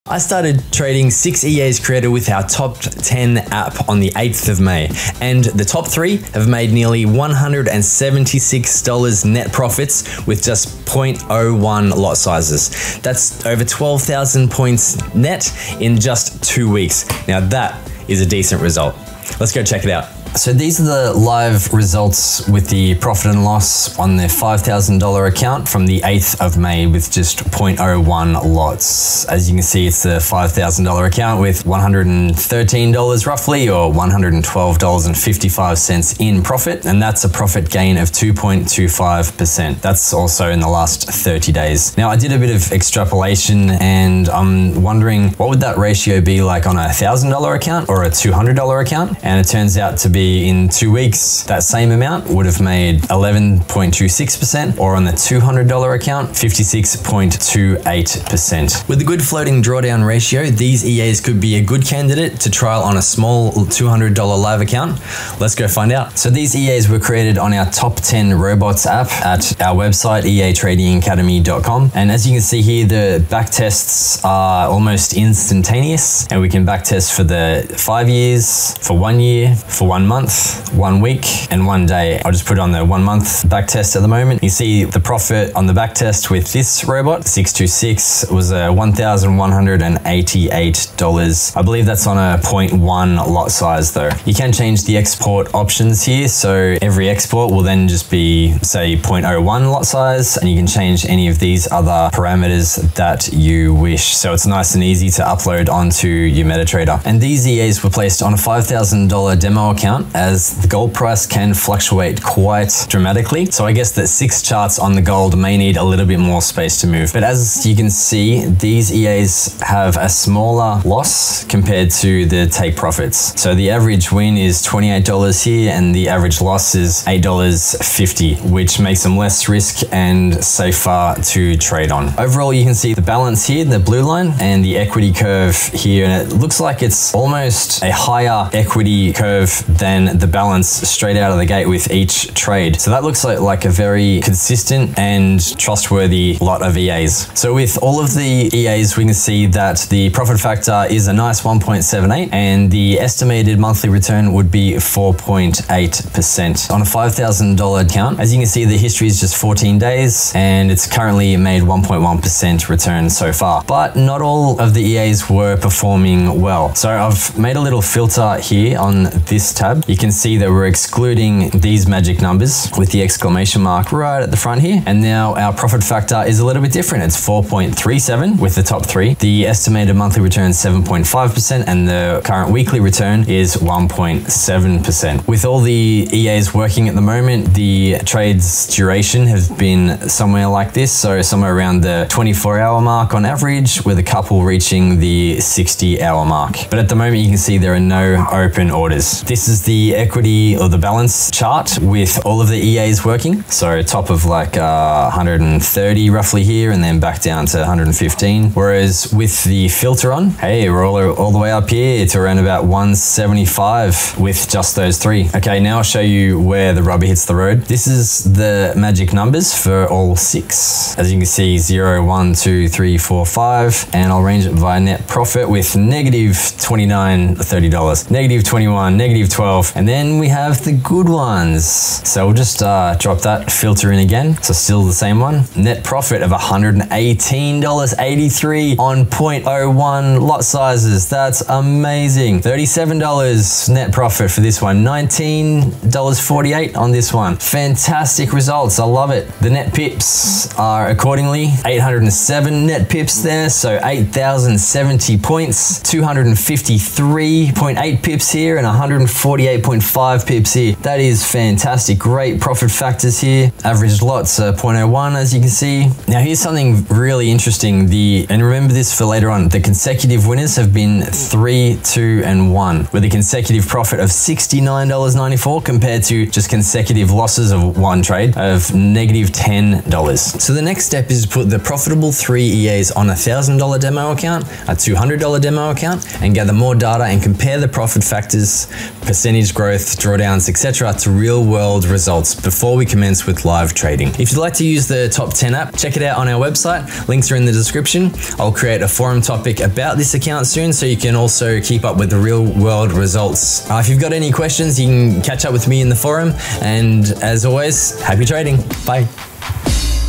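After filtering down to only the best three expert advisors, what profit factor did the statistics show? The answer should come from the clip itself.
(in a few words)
4.37.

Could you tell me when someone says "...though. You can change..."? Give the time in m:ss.
1:33.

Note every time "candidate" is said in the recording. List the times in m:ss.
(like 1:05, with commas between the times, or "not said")
1:01.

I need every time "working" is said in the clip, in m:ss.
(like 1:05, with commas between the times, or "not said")
3:06, 3:23.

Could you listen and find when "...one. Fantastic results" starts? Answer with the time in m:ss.
4:07.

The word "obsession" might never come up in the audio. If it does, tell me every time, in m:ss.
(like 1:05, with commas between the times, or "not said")
not said.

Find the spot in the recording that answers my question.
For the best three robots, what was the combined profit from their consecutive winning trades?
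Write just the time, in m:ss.
4:34.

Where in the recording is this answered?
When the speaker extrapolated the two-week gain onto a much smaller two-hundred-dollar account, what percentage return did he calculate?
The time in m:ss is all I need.
0:56.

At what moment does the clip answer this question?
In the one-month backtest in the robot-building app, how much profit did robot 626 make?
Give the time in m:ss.
1:28.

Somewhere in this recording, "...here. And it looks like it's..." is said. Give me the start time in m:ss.
2:15.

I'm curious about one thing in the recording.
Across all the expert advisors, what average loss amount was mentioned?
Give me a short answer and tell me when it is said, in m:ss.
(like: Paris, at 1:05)
$8.50, at 2:07.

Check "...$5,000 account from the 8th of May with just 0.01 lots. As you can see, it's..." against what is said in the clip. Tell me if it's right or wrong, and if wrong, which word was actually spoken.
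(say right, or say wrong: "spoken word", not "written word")
right.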